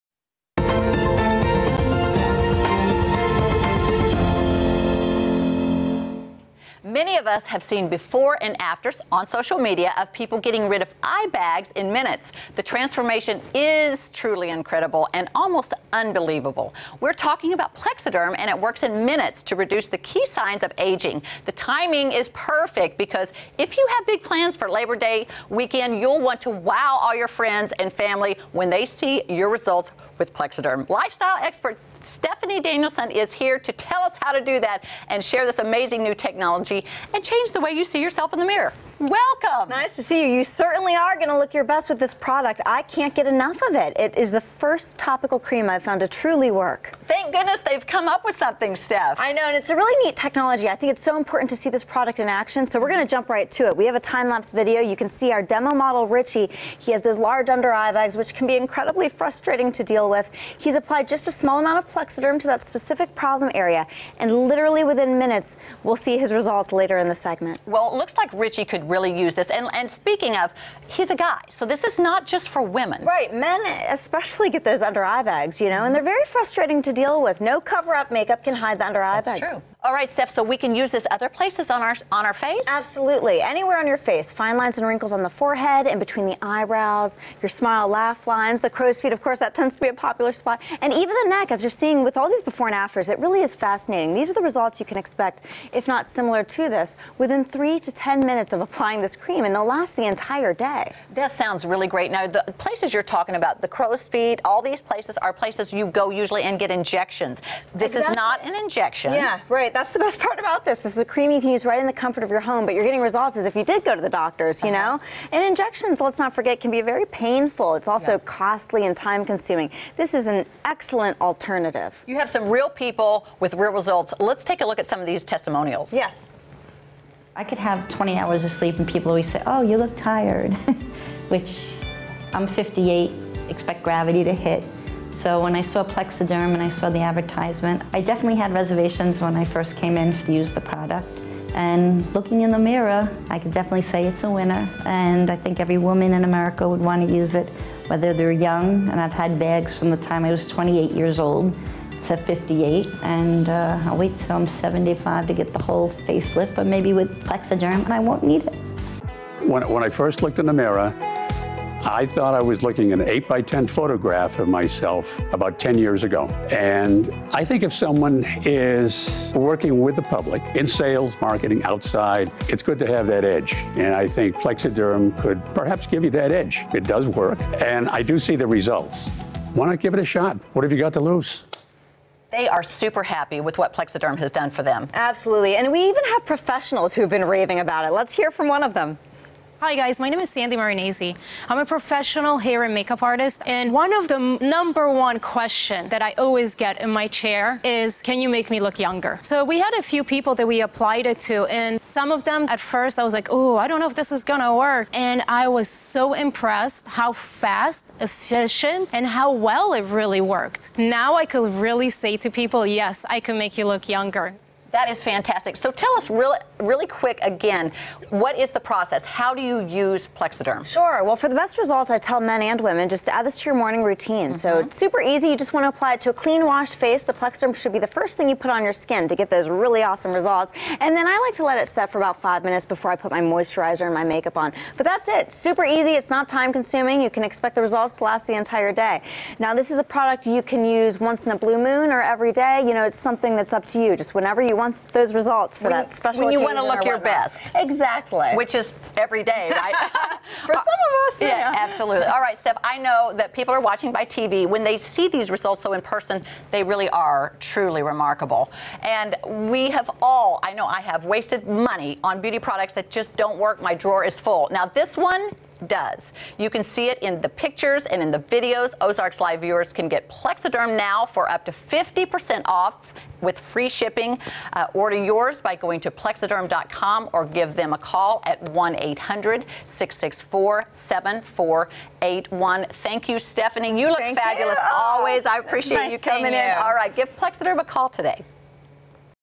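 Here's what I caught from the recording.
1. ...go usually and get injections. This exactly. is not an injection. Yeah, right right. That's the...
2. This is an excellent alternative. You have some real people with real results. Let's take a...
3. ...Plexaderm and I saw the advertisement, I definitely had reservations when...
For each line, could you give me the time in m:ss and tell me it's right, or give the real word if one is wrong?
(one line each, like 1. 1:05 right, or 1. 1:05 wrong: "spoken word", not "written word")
1. 1:45 right
2. 1:59 right
3. 2:15 right.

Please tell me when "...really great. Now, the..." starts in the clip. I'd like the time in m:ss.
1:41.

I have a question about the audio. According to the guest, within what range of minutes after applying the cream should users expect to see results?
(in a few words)
3 to 10 minutes.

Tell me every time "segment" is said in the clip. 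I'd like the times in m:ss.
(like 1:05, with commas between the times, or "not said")
1:07.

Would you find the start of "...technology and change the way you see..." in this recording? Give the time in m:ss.
0:36.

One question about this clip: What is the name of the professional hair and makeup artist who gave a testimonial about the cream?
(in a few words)
Sandy Marinese.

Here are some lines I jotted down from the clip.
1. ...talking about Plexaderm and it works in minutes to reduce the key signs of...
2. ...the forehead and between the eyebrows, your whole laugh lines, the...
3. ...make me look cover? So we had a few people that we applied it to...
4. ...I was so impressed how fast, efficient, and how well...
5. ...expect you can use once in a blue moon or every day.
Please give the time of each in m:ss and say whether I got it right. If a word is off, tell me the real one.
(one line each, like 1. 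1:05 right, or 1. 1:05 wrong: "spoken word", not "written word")
1. 0:17 right
2. 1:25 wrong: "smile", not "whole"
3. 3:18 wrong: "younger", not "cover"
4. 3:25 right
5. 3:59 wrong: "product", not "expect".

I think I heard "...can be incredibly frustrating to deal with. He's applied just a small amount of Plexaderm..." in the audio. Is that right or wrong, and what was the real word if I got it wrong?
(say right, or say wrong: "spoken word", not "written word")
right.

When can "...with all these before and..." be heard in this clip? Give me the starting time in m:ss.
1:32.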